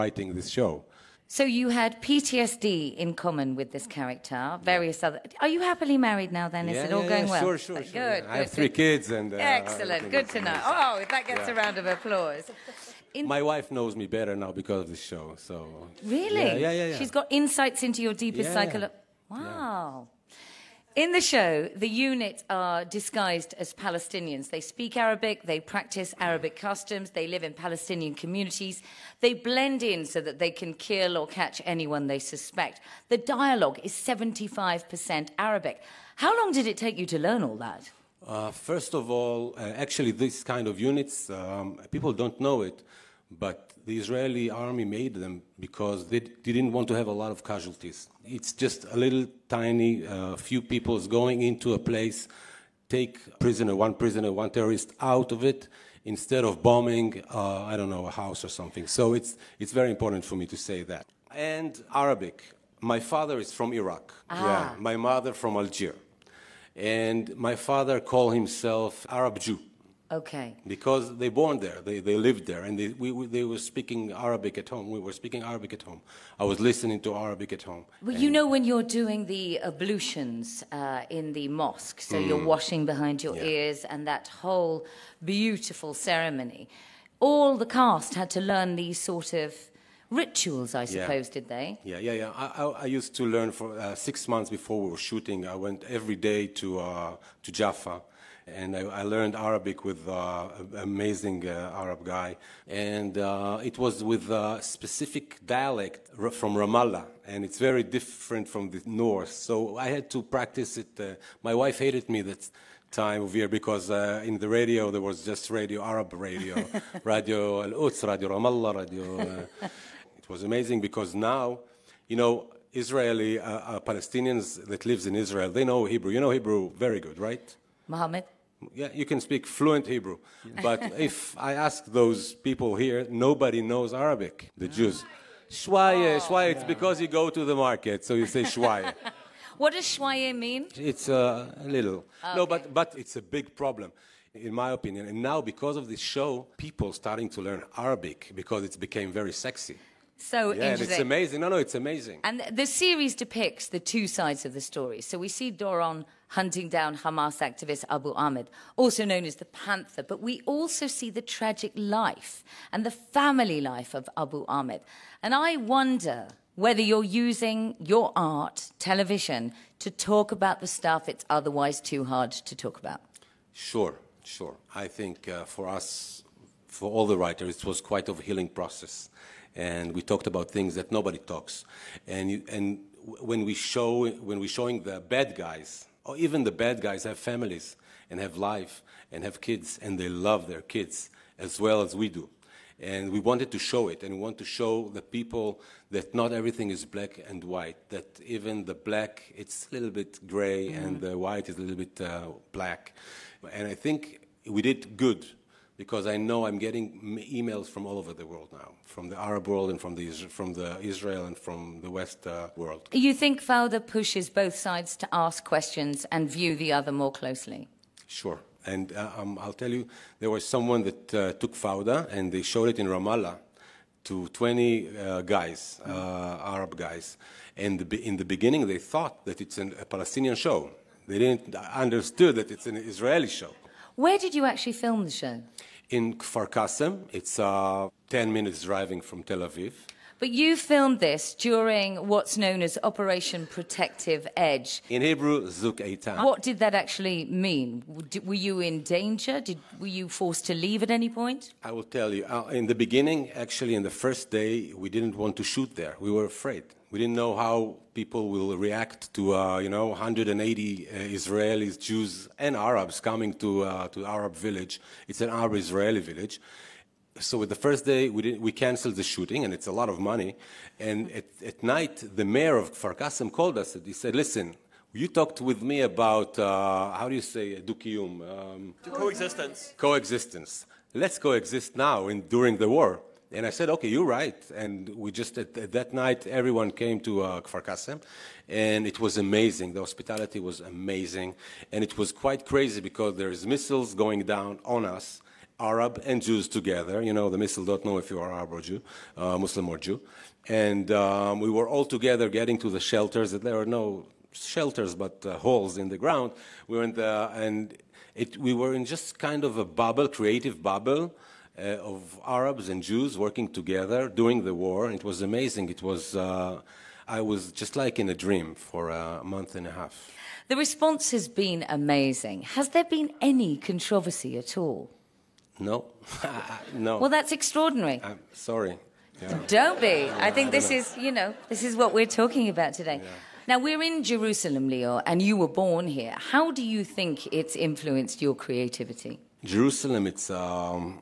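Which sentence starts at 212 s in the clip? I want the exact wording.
You think Fauda pushes both sides to ask questions and view the other more closely?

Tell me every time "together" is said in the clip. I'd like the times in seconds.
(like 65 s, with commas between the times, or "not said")
296 s, 301 s, 313 s.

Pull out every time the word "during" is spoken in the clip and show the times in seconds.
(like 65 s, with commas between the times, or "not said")
241 s, 282 s, 314 s.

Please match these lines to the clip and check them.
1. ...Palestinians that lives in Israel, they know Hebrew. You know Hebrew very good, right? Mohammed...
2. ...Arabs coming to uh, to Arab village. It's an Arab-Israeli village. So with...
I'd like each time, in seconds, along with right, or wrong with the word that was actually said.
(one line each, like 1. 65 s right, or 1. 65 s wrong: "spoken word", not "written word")
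1. 123 s right
2. 262 s right.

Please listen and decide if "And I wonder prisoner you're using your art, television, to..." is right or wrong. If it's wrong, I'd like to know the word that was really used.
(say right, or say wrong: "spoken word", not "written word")
wrong: "whether", not "prisoner".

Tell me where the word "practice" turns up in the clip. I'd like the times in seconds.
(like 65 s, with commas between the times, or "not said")
25 s, 110 s.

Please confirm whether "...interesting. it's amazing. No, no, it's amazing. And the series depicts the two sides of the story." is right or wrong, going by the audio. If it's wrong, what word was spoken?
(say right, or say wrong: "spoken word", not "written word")
right.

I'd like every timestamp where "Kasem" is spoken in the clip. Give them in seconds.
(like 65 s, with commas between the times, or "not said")
236 s, 287 s.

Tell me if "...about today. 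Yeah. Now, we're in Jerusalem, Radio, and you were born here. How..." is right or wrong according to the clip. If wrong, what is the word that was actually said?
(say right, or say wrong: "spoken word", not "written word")
wrong: "Lior", not "Radio".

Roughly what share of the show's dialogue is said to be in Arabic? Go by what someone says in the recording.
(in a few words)
75%.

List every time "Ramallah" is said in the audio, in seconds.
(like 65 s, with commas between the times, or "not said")
106 s, 118 s, 222 s.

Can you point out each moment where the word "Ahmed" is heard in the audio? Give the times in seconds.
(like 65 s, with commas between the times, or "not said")
158 s, 164 s.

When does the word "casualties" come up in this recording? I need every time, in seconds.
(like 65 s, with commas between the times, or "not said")
47 s.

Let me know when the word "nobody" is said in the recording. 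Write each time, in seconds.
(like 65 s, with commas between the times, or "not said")
133 s, 180 s.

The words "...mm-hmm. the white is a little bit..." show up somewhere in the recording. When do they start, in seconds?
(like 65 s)
200 s.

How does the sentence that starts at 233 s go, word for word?
Where did you actually film the show?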